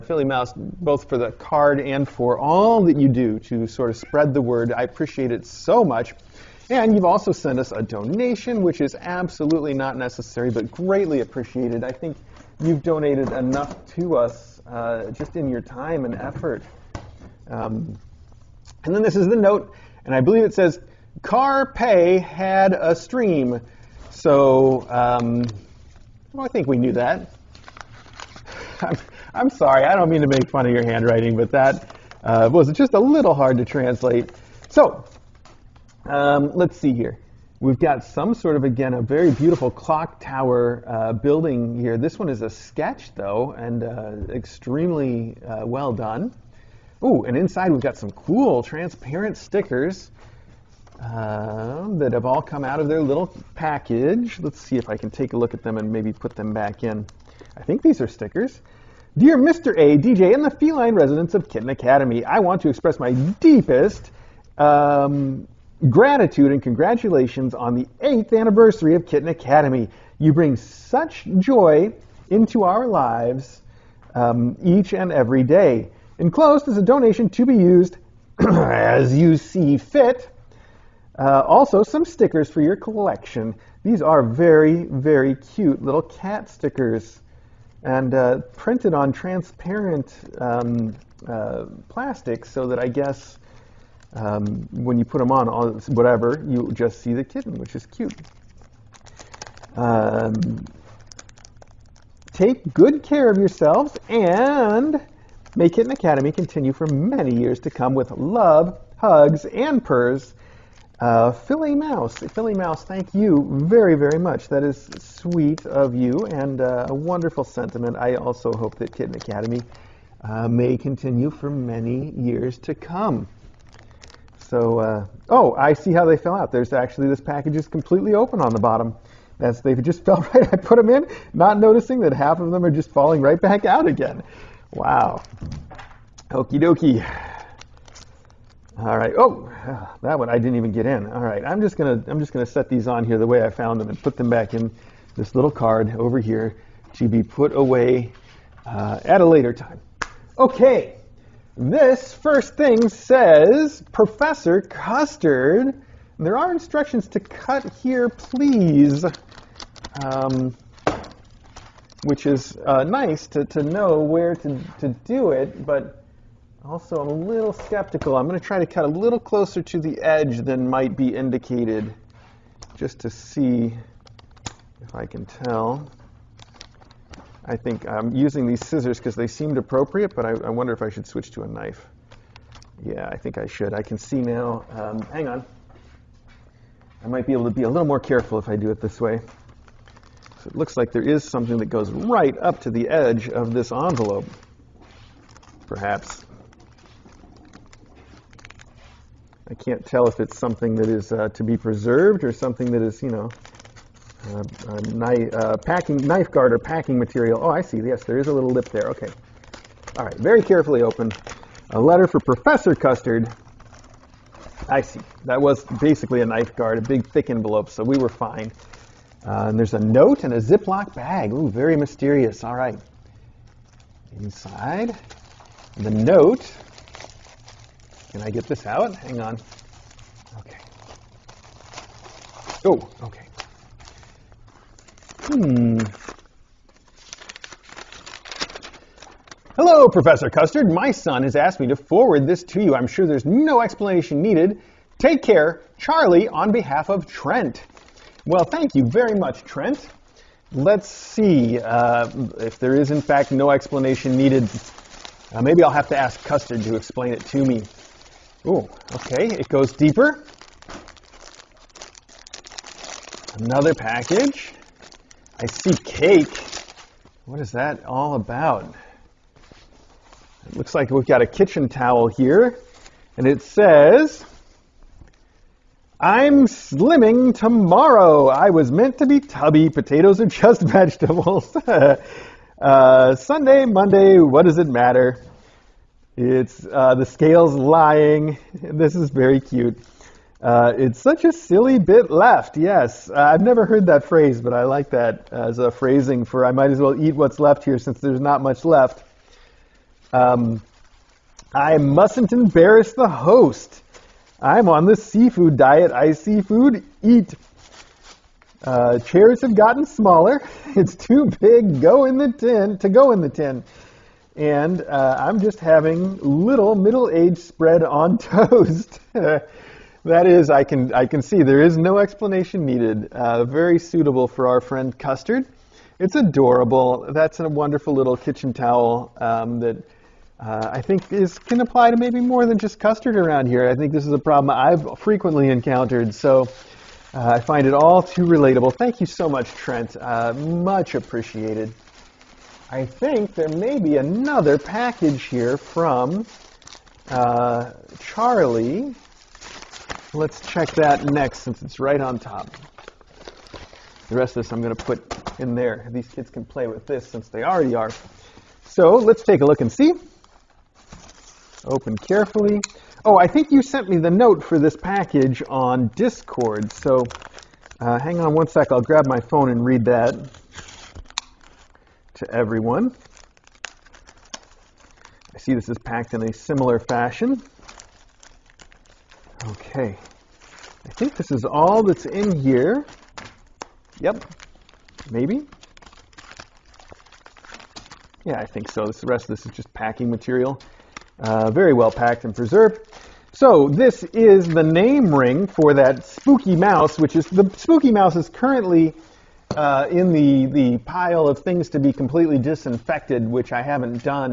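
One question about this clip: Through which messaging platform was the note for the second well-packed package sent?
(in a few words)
Discord.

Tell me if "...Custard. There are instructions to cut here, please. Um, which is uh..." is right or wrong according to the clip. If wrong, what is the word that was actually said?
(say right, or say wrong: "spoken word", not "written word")
right.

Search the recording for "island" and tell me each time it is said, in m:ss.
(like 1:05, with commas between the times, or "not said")
not said.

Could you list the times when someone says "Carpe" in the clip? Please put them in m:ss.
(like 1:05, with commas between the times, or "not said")
0:21.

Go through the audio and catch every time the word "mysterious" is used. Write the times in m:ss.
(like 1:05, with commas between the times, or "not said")
3:41.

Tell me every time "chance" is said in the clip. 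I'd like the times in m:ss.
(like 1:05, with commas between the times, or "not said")
not said.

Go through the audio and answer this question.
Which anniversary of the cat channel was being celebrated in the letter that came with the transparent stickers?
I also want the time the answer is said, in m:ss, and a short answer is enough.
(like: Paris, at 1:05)
Eighth, at 1:08.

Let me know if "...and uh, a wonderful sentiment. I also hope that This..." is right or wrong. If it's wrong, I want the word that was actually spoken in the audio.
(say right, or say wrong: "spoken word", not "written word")
wrong: "Kitten", not "This".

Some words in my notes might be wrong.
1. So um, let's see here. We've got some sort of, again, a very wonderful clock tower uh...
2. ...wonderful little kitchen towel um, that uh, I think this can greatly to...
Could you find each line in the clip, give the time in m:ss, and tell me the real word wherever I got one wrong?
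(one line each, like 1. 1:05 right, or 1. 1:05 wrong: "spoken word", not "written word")
1. 0:34 wrong: "beautiful", not "wonderful"
2. 5:27 wrong: "apply", not "greatly".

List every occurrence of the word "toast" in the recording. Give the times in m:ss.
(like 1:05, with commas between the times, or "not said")
5:18.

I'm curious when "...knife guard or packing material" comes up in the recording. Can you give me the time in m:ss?
3:26.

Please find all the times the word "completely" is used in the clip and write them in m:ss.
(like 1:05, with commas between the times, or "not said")
2:07, 6:41.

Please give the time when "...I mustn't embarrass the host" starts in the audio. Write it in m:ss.
5:01.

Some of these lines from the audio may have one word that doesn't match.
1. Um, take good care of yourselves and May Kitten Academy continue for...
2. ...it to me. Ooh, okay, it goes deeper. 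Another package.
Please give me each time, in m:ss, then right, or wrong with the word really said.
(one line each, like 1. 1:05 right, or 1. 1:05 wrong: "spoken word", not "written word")
1. 1:39 right
2. 4:17 right.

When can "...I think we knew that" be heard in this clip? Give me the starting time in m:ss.
0:26.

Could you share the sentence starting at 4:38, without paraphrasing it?
I was meant to be tubby.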